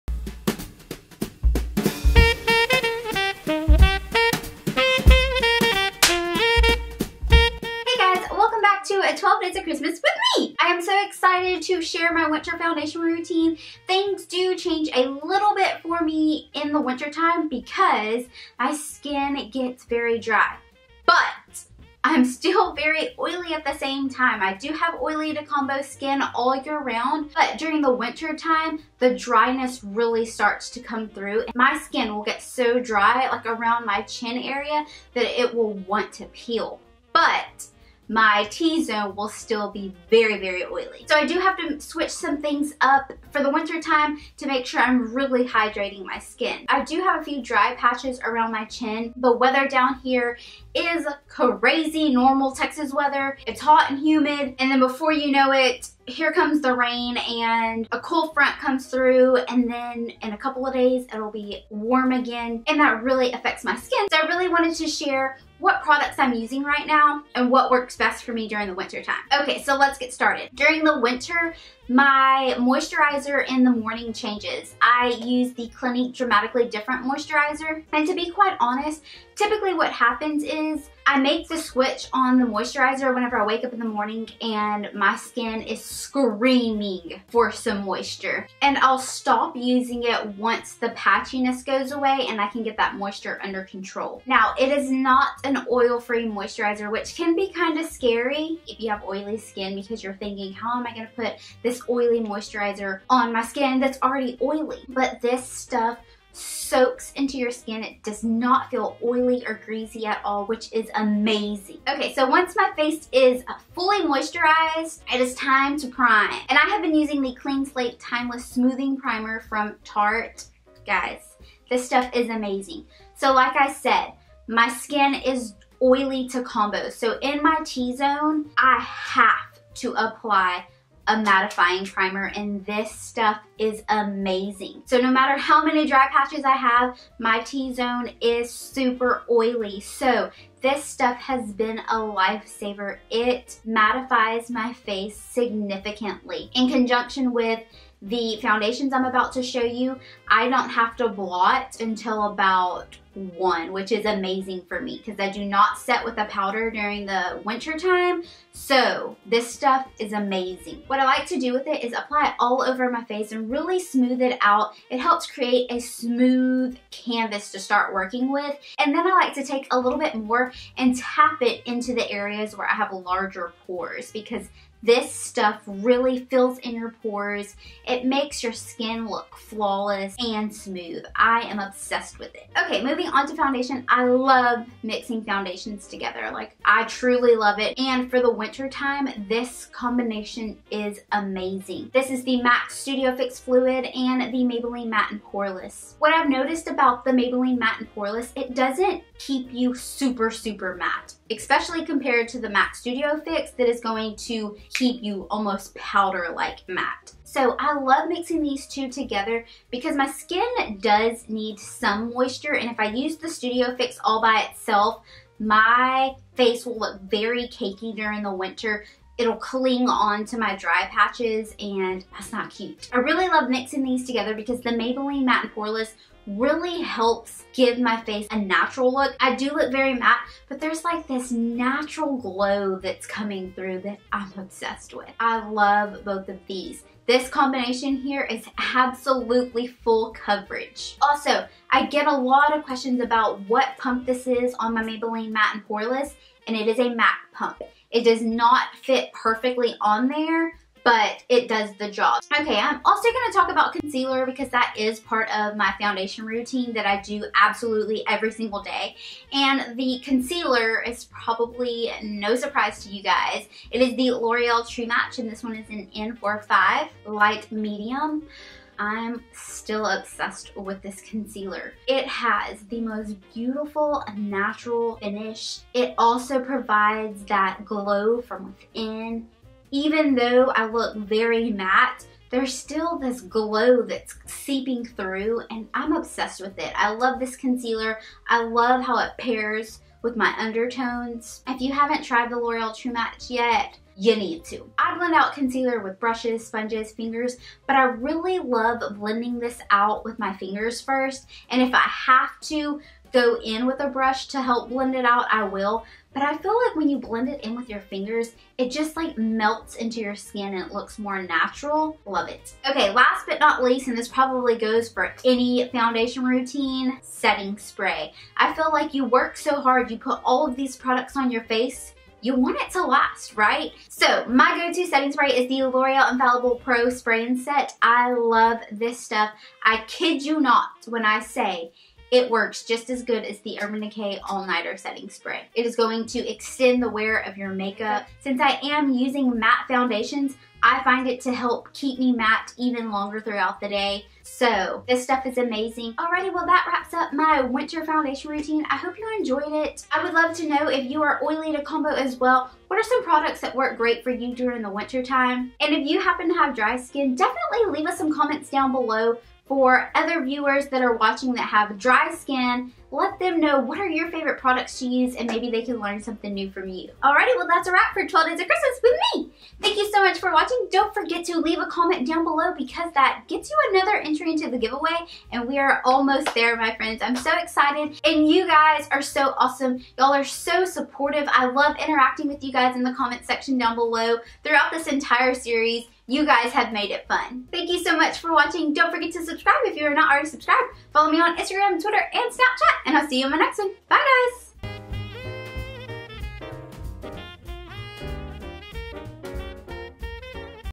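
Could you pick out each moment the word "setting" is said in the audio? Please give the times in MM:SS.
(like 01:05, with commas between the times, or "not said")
05:17, 05:24, 05:34.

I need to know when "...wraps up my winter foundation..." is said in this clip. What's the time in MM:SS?
05:46.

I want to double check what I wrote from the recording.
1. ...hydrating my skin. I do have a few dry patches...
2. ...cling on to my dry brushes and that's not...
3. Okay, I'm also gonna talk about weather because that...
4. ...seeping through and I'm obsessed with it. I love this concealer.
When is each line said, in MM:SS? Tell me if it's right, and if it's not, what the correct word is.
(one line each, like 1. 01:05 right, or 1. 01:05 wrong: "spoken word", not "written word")
1. 00:45 right
2. 03:39 wrong: "patches", not "brushes"
3. 04:12 wrong: "concealer", not "weather"
4. 04:44 right.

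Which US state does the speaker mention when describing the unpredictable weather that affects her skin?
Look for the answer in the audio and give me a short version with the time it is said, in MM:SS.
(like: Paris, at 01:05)
Texas, at 00:52.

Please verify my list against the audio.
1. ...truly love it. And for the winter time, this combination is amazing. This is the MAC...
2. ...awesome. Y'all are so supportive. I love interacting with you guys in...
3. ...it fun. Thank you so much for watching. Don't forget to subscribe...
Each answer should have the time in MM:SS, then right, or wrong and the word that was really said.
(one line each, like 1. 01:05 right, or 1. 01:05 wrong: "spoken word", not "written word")
1. 03:06 right
2. 06:19 right
3. 06:26 right.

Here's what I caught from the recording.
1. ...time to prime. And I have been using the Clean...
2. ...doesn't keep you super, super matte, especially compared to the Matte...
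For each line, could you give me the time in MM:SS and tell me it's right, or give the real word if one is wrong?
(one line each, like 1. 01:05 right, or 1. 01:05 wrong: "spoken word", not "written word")
1. 01:55 right
2. 03:18 wrong: "MAC", not "Matte".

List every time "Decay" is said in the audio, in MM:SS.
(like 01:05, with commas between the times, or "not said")
05:33.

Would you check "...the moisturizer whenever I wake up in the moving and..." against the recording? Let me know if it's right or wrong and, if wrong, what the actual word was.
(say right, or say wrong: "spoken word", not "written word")
wrong: "morning", not "moving".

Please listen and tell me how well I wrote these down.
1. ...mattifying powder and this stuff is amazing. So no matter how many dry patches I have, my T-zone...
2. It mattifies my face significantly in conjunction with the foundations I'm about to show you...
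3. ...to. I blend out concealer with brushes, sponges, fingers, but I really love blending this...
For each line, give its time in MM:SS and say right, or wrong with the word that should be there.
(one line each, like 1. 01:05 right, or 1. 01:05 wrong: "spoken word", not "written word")
1. 02:11 wrong: "primer", not "powder"
2. 02:23 right
3. 04:54 right.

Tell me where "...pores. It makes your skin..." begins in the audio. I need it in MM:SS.
02:57.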